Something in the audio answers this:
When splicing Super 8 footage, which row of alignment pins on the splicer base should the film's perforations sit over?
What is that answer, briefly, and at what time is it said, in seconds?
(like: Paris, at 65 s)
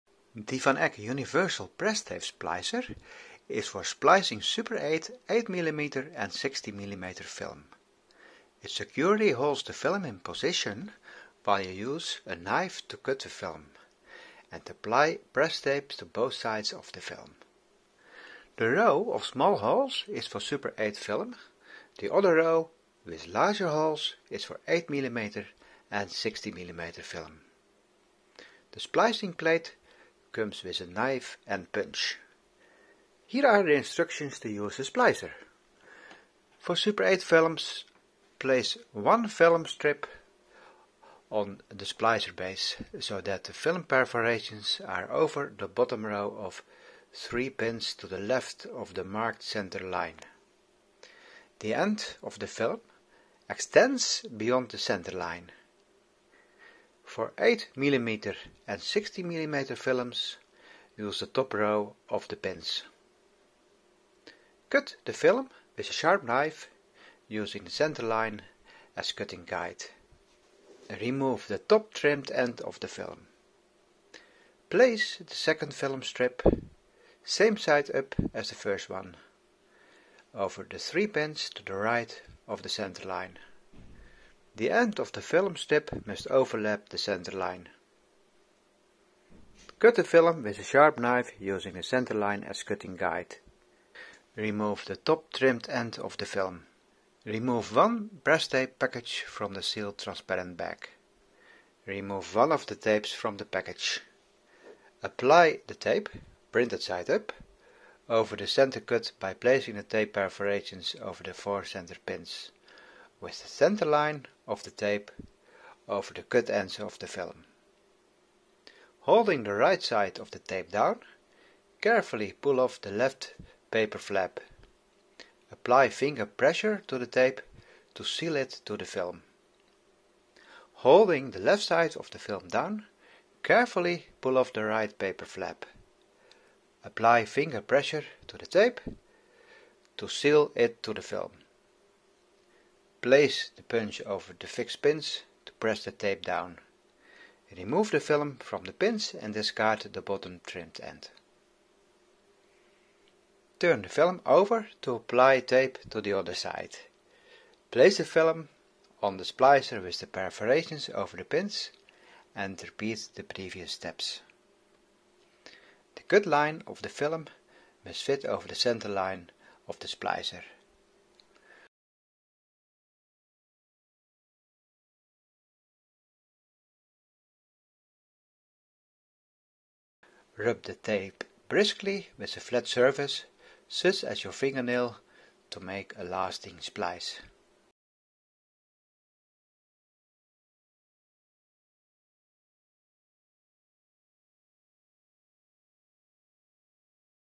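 bottom row, at 45 s.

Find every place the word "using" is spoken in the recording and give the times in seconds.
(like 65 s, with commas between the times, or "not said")
67 s, 91 s.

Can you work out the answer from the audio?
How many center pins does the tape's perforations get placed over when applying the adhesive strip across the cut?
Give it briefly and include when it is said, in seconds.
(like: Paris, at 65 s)
4, at 111 s.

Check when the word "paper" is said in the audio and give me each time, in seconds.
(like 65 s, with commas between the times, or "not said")
123 s, 134 s.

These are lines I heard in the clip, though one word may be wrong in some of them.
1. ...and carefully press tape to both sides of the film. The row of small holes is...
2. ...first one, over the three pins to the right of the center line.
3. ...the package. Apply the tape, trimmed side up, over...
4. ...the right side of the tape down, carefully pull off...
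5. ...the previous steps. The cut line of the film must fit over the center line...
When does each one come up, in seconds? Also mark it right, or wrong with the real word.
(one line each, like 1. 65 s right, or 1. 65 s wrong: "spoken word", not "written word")
1. 14 s wrong: "apply", not "carefully"
2. 78 s right
3. 103 s wrong: "printed", not "trimmed"
4. 119 s right
5. 163 s right.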